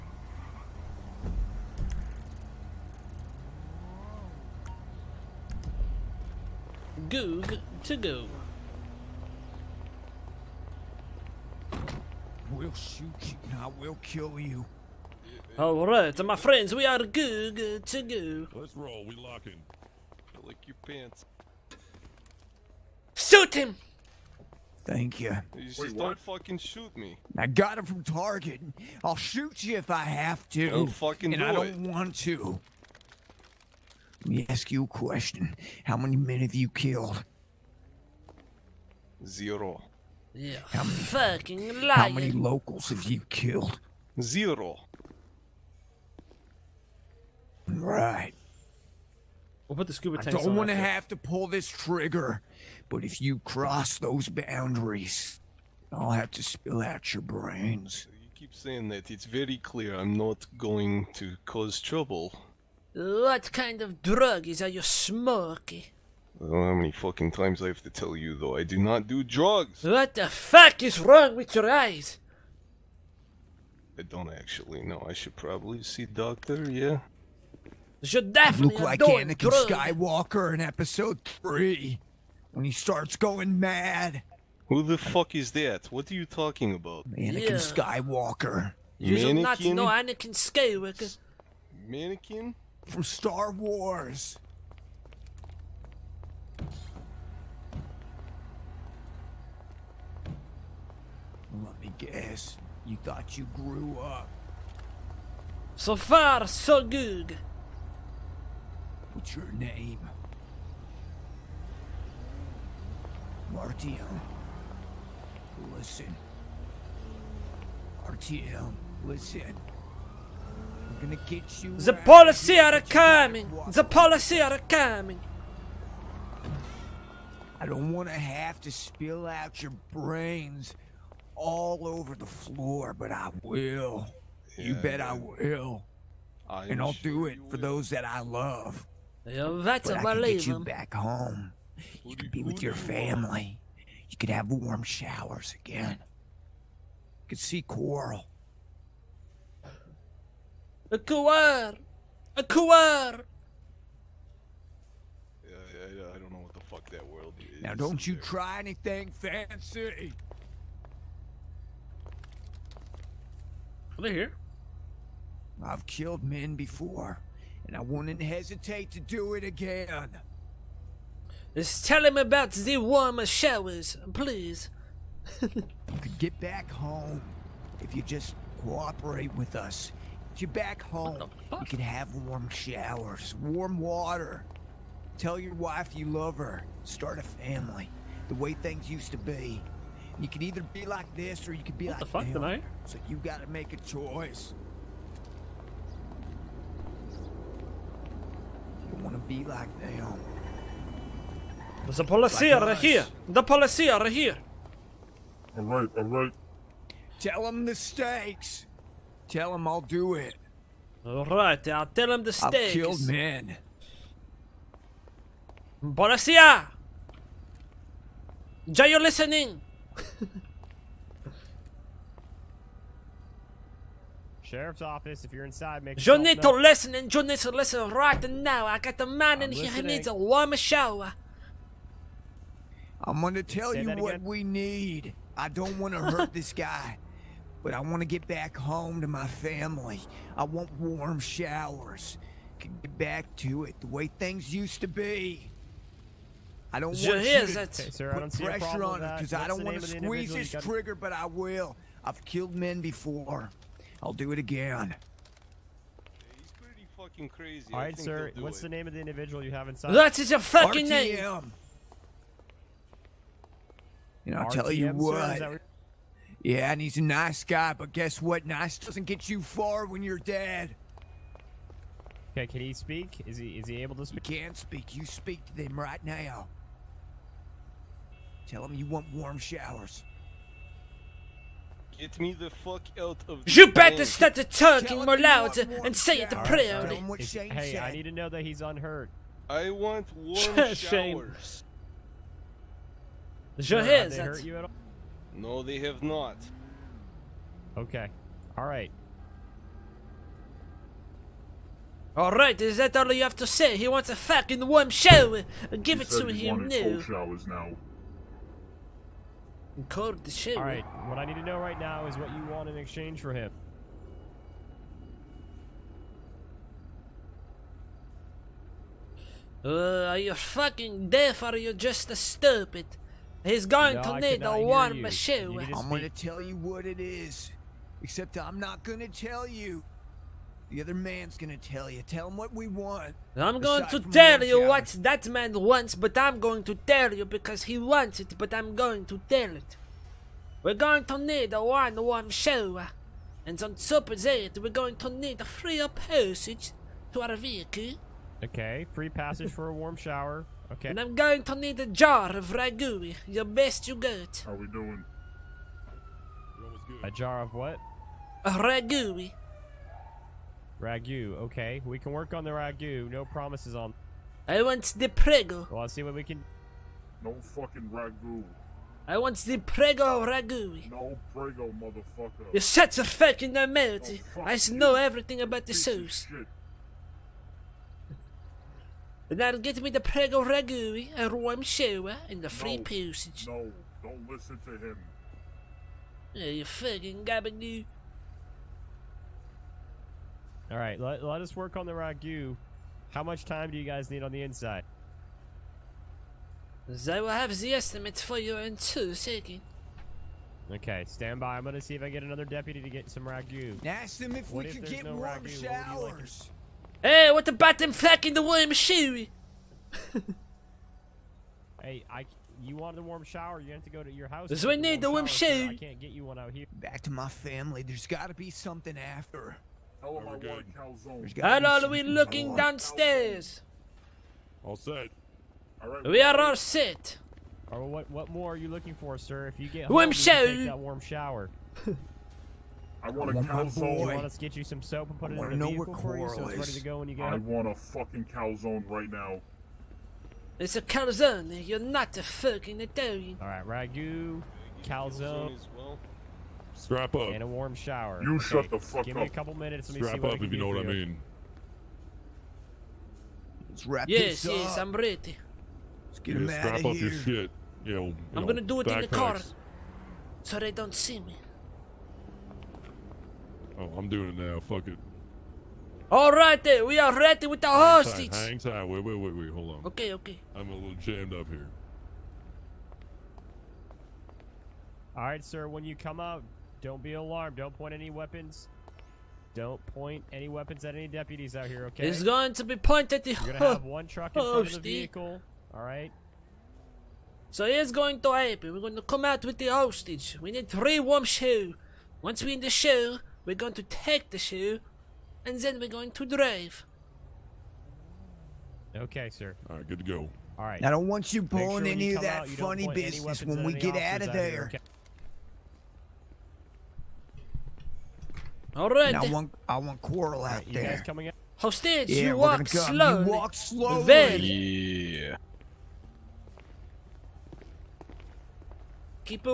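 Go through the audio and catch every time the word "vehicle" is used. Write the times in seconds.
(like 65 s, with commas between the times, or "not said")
347 s, 435 s, 484 s.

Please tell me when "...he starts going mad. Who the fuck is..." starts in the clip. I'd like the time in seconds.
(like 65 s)
82 s.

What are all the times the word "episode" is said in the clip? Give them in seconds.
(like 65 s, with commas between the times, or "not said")
80 s.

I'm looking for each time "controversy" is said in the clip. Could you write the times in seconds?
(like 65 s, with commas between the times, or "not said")
not said.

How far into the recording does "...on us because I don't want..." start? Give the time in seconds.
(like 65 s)
248 s.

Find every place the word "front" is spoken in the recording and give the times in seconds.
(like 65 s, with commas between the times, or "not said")
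484 s.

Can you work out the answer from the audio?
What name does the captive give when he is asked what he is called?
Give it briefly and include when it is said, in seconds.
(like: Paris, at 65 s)
Martiel, at 113 s.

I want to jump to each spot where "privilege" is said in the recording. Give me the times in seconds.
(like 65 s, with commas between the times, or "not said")
not said.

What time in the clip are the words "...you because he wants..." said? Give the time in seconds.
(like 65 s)
337 s.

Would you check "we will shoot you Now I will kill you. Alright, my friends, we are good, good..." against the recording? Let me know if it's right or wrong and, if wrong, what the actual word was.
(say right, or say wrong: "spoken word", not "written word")
right.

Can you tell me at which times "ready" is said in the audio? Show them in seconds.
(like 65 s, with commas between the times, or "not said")
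436 s, 454 s, 467 s.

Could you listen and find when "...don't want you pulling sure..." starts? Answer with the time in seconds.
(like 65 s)
500 s.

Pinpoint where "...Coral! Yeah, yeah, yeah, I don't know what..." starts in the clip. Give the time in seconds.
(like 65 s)
152 s.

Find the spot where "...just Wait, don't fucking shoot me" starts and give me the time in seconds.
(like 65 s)
25 s.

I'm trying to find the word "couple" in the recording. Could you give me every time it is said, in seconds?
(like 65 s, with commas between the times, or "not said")
449 s.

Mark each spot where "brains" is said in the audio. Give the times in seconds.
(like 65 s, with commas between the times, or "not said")
57 s, 129 s.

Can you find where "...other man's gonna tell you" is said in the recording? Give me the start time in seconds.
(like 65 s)
330 s.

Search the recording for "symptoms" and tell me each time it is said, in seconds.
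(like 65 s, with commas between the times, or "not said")
not said.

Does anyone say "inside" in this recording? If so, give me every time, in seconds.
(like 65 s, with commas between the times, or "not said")
225 s, 259 s, 394 s.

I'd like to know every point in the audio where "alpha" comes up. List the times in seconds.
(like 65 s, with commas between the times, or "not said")
not said.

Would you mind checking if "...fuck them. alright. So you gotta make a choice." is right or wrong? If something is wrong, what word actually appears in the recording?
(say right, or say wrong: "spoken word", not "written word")
wrong: "tonight", not "alright".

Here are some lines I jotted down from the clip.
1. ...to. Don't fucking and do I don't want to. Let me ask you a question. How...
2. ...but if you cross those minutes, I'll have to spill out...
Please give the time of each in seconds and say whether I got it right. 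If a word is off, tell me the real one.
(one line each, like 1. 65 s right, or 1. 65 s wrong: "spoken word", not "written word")
1. 30 s right
2. 52 s wrong: "boundaries", not "minutes".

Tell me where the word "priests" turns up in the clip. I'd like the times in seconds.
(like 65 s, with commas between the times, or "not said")
not said.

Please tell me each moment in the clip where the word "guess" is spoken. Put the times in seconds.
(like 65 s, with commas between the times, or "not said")
102 s, 267 s.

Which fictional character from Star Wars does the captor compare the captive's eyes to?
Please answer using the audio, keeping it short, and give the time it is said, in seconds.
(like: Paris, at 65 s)
Anakin Skywalker, at 89 s.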